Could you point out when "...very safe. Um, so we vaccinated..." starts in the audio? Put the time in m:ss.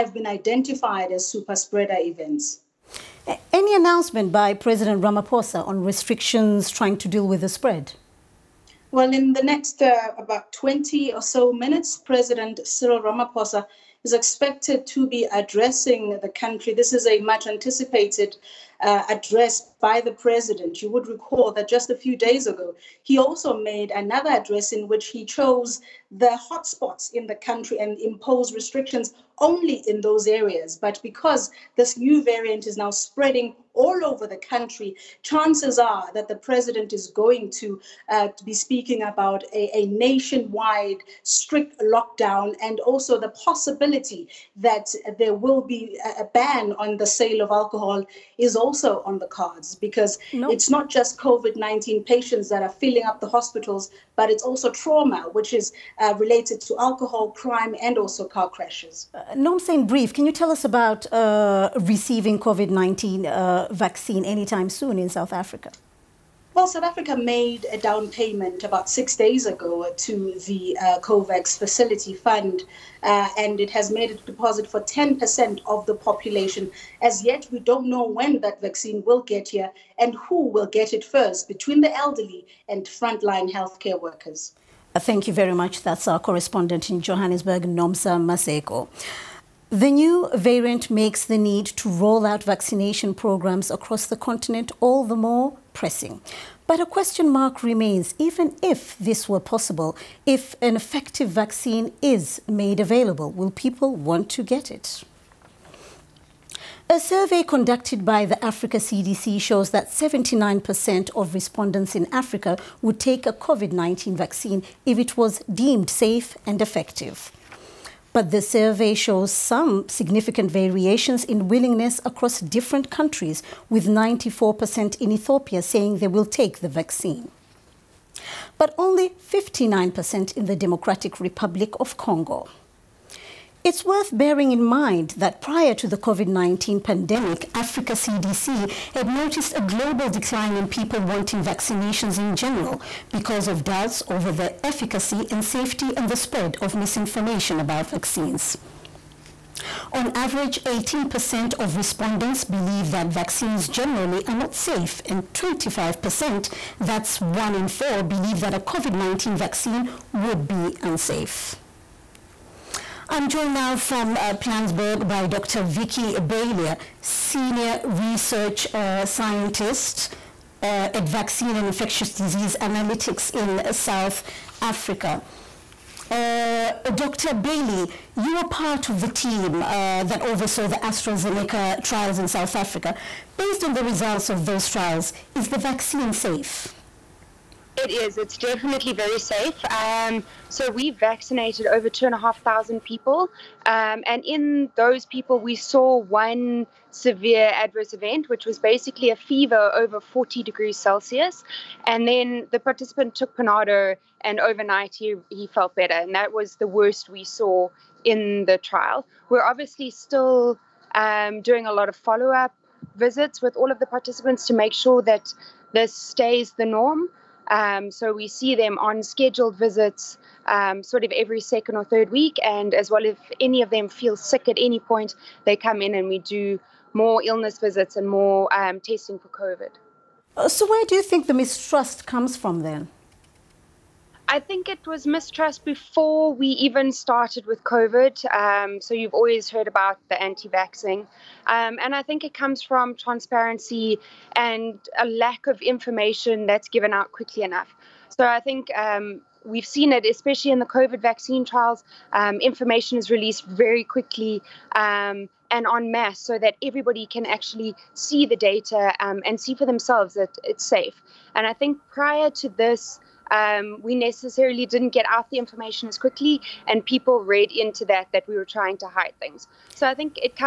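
3:08.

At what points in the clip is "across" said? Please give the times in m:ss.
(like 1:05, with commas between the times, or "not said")
1:33, 2:02.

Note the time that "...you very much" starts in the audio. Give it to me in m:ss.
1:25.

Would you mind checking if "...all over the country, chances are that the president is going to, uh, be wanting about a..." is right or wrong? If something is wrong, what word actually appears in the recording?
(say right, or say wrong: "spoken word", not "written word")
wrong: "speaking", not "wanting".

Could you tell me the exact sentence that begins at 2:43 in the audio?
I'm joined now from uh, Plansberg by Dr.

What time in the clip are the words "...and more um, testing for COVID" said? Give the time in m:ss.
3:47.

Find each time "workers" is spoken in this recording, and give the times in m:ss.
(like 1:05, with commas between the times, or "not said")
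1:23.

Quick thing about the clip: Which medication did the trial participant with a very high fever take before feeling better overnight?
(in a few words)
Panado.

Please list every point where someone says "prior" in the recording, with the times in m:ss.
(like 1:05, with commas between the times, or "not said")
2:15, 4:21.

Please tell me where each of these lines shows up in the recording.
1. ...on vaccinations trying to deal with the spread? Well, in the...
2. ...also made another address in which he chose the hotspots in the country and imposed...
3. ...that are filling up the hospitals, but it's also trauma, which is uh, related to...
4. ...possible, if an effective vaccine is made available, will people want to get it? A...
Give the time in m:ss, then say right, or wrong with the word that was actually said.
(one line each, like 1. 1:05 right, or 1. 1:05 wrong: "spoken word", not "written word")
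1. 0:05 wrong: "restrictions", not "vaccinations"
2. 0:23 right
3. 0:52 right
4. 1:39 right.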